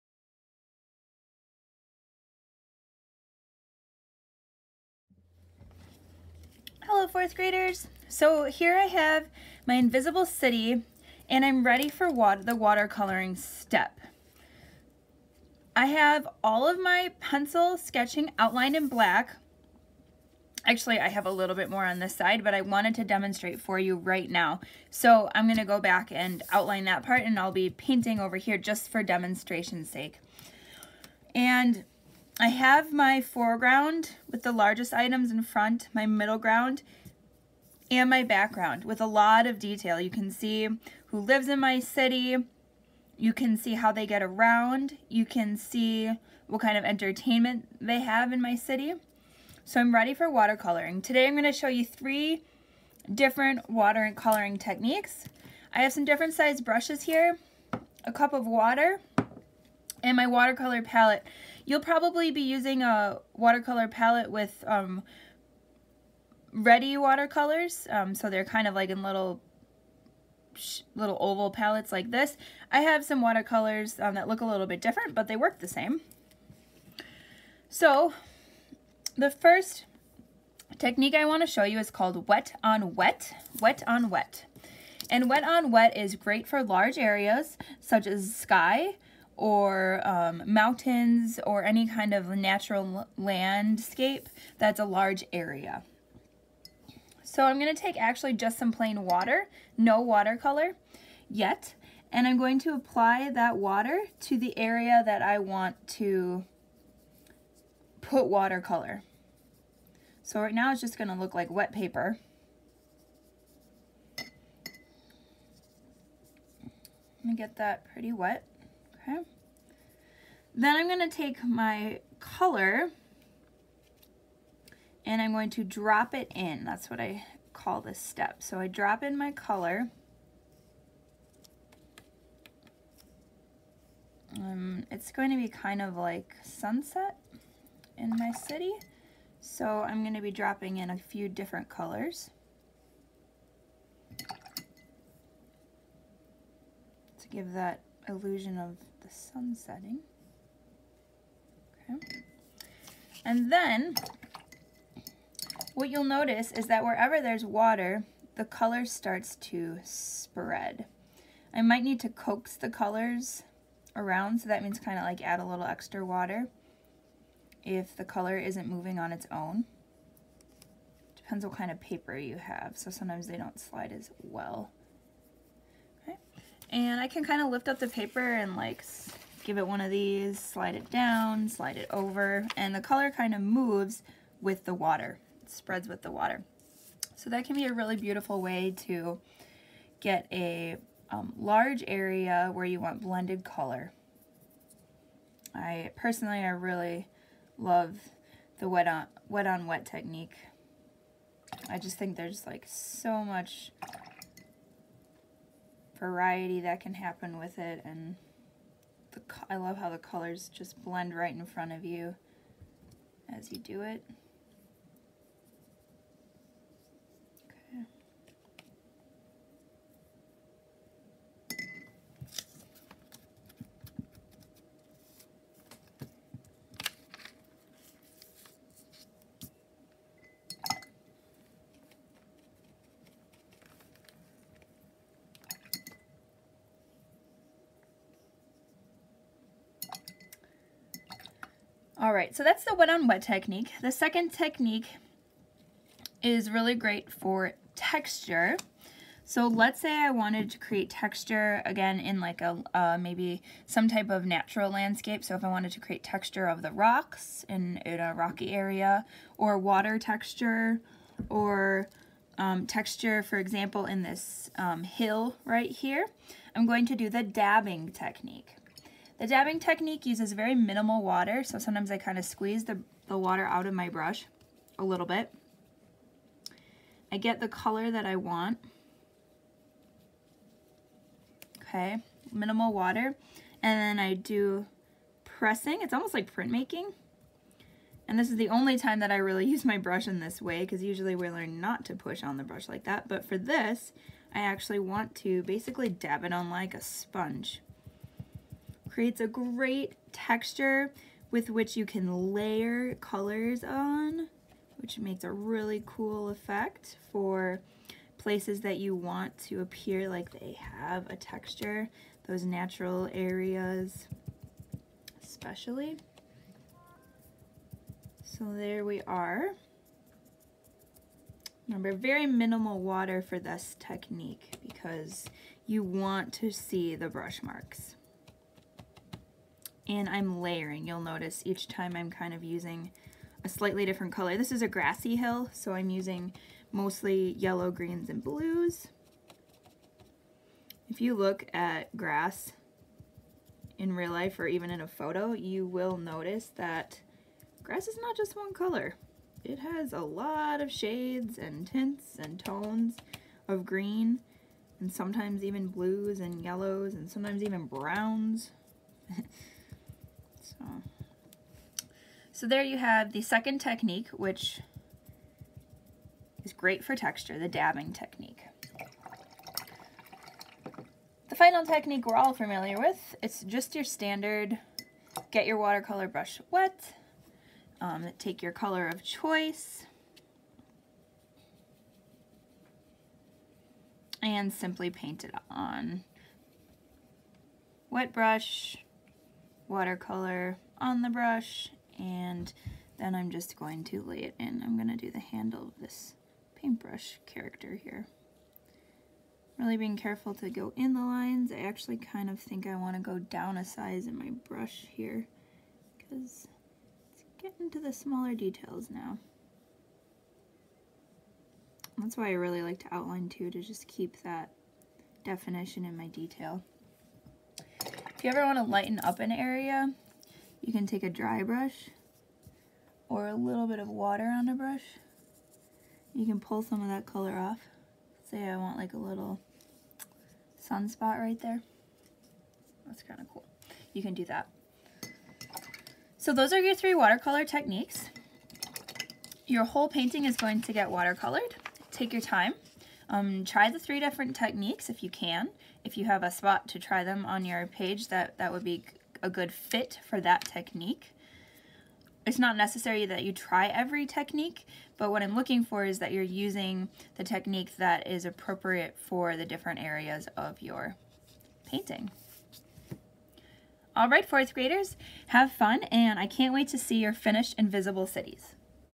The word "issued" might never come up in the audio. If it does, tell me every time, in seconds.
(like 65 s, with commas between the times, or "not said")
not said.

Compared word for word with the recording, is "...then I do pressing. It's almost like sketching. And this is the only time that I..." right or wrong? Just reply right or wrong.
wrong.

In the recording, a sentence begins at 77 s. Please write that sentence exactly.
So the first technique I want to show you is called wet on wet, wet on wet.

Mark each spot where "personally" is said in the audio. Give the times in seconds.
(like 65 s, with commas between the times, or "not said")
195 s.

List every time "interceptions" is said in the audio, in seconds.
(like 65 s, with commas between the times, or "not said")
not said.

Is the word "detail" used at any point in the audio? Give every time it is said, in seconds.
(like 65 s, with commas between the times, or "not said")
39 s, 408 s, 416 s.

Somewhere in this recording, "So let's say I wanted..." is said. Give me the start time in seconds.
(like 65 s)
249 s.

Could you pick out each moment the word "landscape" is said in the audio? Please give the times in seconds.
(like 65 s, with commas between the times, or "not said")
93 s, 254 s.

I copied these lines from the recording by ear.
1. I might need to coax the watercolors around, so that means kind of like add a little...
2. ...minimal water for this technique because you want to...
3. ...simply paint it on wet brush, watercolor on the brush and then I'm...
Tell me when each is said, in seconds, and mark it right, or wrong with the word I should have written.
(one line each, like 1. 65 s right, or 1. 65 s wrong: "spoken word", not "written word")
1. 161 s wrong: "colors", not "watercolors"
2. 322 s right
3. 384 s right.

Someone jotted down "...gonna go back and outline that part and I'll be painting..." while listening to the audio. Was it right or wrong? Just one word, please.
right.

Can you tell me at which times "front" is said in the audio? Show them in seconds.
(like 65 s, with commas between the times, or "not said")
35 s, 211 s.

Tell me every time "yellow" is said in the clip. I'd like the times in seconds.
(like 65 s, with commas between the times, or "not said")
337 s, 356 s.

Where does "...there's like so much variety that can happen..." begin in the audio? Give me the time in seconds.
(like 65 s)
202 s.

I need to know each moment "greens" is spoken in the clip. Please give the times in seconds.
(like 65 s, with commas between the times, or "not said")
337 s, 353 s.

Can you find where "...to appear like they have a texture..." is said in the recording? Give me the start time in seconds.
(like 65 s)
309 s.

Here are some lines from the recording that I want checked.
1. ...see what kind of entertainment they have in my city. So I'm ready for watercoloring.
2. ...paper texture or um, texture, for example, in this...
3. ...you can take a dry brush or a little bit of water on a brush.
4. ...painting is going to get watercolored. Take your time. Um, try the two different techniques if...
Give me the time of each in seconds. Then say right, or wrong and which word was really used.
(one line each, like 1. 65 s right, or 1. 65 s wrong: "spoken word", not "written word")
1. 45 s right
2. 259 s wrong: "water", not "paper"
3. 420 s right
4. 439 s wrong: "three", not "two".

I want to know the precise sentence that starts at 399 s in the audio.
Really being careful to go in the lines.